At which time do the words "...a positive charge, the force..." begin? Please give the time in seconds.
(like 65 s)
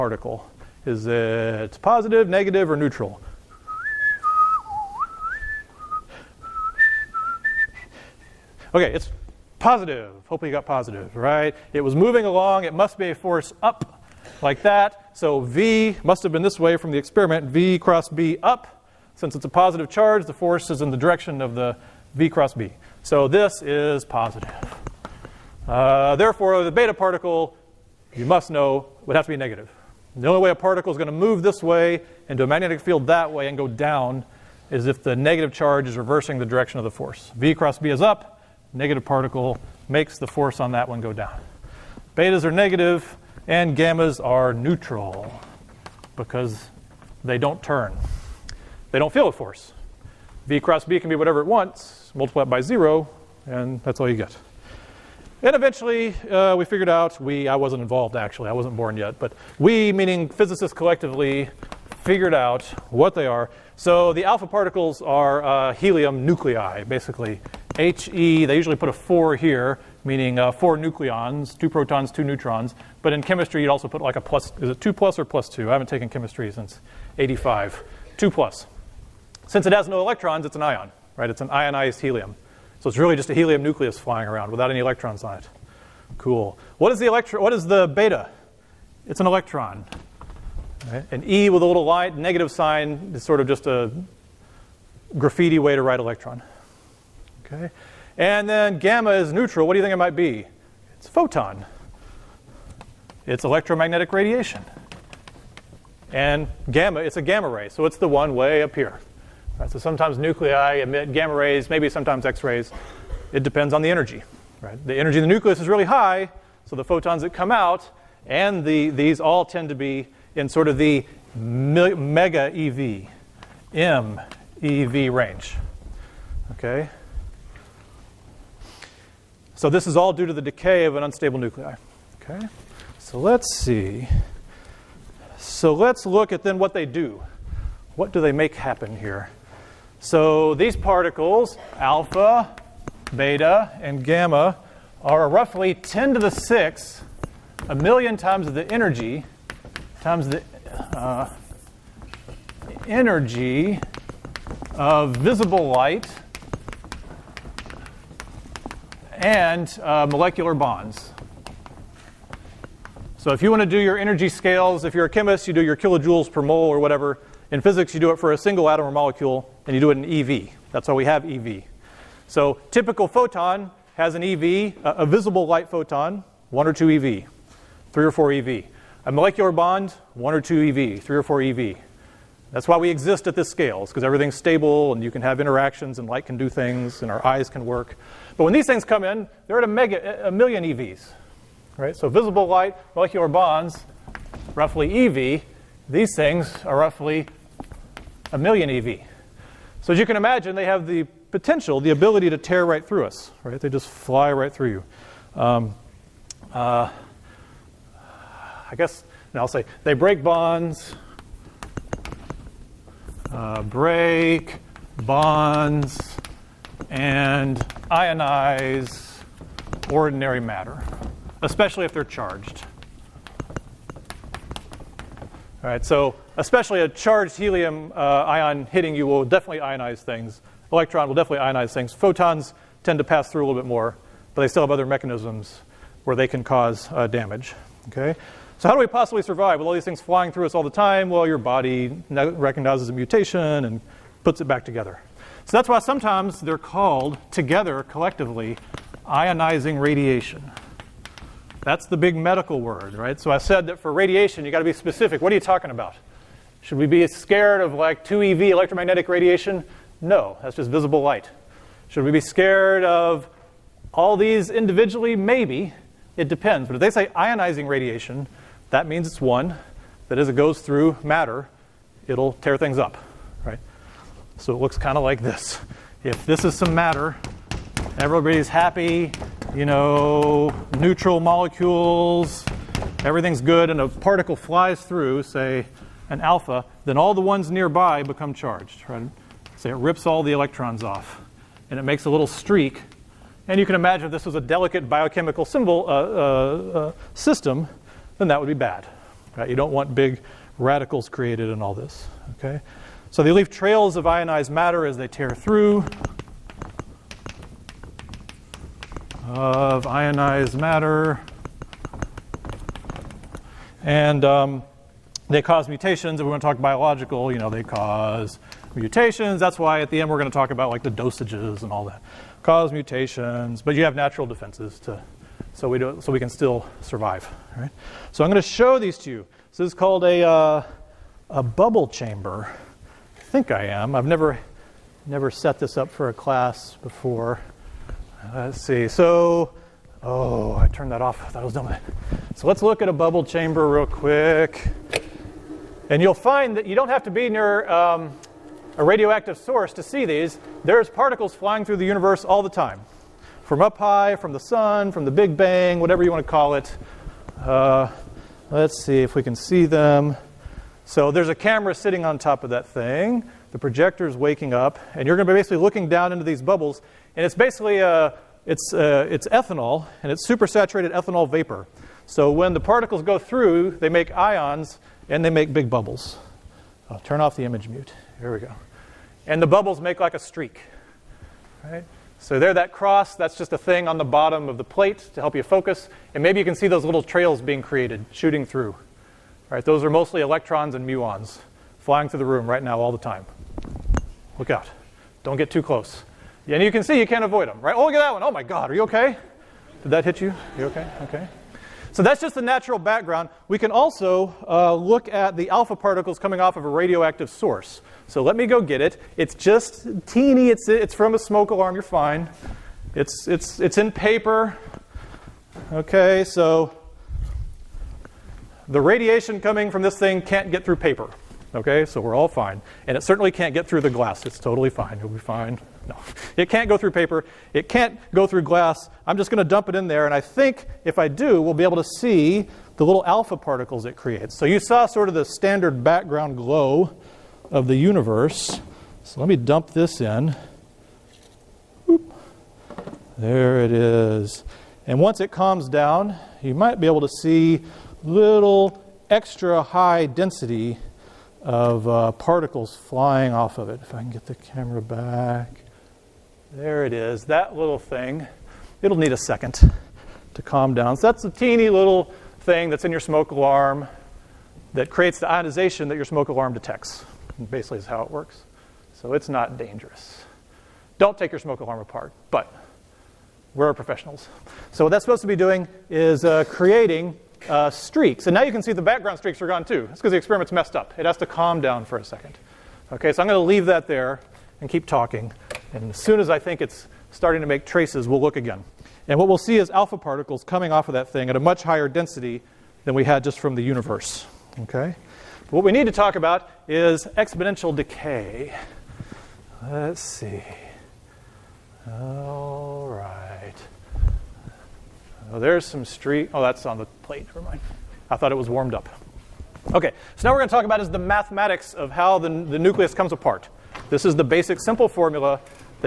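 19 s.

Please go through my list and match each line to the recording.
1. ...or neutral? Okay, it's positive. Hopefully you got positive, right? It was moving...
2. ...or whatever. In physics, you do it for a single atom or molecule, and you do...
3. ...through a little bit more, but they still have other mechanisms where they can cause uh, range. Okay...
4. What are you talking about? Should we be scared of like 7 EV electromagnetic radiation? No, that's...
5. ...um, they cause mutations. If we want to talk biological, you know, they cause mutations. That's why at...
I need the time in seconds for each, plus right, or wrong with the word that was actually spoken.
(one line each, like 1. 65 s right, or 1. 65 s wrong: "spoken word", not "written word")
1. 2 s right
2. 166 s right
3. 233 s wrong: "damage", not "range"
4. 255 s wrong: "2", not "7"
5. 314 s right.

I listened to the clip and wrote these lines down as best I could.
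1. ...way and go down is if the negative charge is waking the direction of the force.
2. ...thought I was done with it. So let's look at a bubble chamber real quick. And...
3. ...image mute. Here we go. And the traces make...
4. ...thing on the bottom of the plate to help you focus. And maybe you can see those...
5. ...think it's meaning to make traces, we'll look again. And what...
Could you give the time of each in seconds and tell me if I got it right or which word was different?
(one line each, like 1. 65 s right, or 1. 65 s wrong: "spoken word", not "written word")
1. 33 s wrong: "reversing", not "waking"
2. 341 s right
3. 377 s wrong: "bubbles", not "traces"
4. 383 s right
5. 486 s wrong: "starting", not "meaning".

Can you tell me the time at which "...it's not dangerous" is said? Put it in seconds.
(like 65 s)
469 s.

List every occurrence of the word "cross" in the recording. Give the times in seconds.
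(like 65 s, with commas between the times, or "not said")
17 s, 22 s, 37 s, 50 s, 382 s.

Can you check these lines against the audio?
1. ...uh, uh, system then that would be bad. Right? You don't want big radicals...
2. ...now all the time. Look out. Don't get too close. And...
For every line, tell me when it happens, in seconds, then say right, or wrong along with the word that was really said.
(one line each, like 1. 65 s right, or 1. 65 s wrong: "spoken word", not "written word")
1. 295 s right
2. 392 s right.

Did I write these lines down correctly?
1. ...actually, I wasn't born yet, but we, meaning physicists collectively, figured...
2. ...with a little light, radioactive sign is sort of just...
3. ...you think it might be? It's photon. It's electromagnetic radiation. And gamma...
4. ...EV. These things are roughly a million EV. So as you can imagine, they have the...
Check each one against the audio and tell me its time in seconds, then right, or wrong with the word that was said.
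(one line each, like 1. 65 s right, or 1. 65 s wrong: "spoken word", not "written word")
1. 58 s right
2. 91 s wrong: "negative", not "radioactive"
3. 99 s right
4. 195 s right.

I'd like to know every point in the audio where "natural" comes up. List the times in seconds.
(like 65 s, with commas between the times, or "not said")
323 s, 402 s.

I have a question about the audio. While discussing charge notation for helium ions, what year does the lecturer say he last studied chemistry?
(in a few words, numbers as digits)
1985.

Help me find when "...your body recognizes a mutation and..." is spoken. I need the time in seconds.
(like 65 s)
241 s.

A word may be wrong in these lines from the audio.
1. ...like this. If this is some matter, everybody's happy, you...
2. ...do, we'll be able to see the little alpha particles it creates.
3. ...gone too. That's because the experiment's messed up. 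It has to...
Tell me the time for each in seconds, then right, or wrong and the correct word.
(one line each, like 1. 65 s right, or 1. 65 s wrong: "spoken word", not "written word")
1. 275 s right
2. 431 s right
3. 479 s right.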